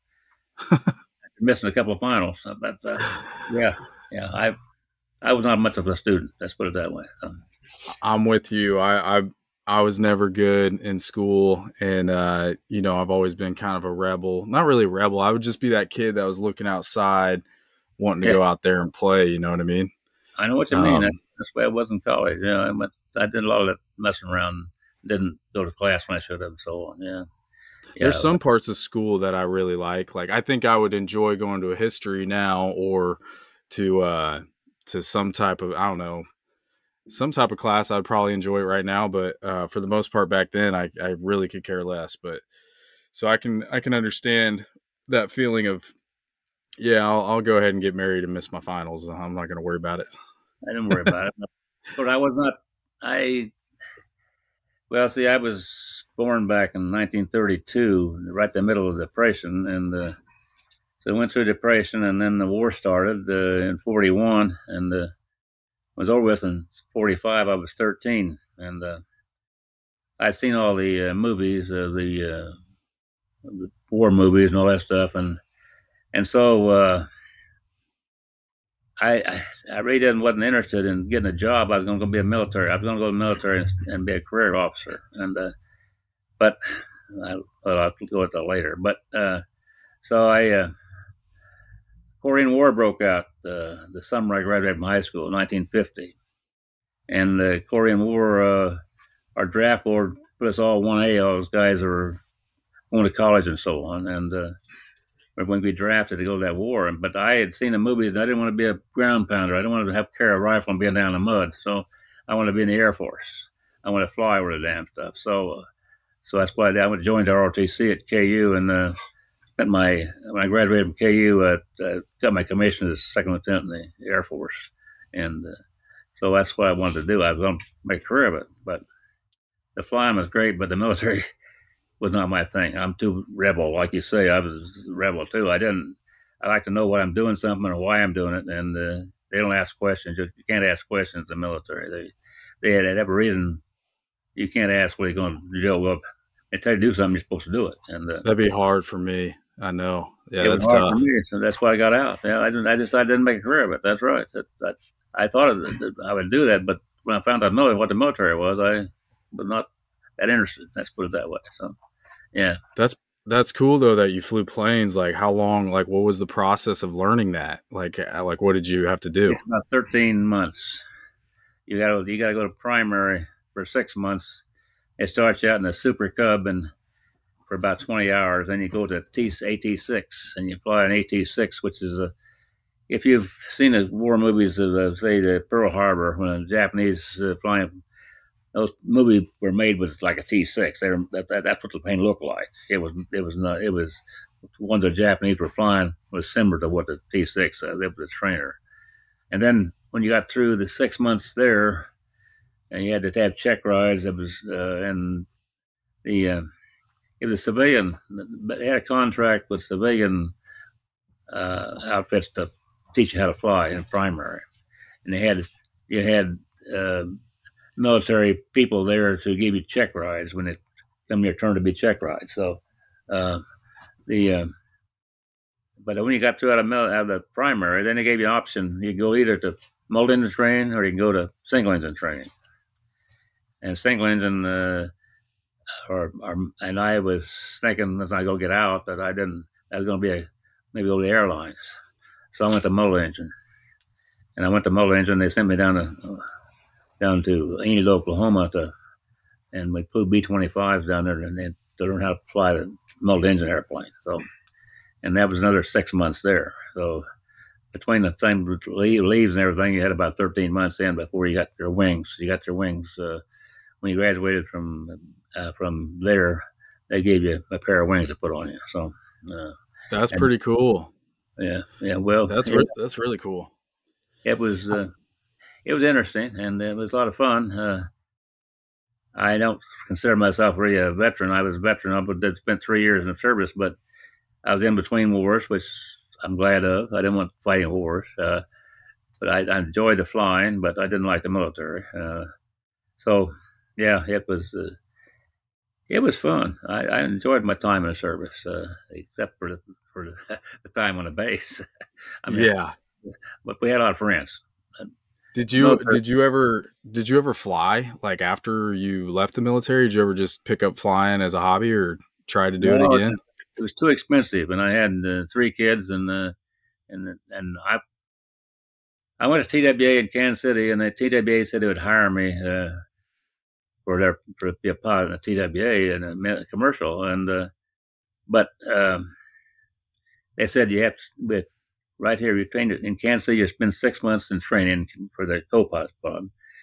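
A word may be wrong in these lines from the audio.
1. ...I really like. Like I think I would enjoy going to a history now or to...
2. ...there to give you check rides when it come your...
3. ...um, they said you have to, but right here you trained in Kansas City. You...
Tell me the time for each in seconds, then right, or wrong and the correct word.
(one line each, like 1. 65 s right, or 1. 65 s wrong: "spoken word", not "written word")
1. 29 s right
2. 218 s right
3. 328 s right.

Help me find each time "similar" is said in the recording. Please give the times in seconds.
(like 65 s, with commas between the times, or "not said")
196 s.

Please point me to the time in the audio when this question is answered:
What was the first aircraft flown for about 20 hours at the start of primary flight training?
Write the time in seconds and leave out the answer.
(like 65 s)
175 s.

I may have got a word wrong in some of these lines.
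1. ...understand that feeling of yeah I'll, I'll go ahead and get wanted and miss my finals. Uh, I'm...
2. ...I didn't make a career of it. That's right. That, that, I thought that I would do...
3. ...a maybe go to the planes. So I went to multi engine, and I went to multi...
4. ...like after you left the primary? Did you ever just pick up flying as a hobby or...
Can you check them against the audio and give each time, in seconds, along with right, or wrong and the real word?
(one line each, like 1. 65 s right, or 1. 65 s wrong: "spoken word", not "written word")
1. 43 s wrong: "married", not "wanted"
2. 153 s right
3. 240 s wrong: "airlines", not "planes"
4. 308 s wrong: "military", not "primary".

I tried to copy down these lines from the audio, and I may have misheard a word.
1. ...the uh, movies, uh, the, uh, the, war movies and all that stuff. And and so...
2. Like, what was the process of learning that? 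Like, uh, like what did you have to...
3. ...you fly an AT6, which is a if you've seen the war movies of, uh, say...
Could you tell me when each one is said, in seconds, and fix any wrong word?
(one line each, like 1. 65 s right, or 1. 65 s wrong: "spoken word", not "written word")
1. 70 s right
2. 165 s right
3. 180 s right.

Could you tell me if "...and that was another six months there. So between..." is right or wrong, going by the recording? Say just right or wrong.
right.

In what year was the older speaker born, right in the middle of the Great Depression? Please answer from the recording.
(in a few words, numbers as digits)
1932.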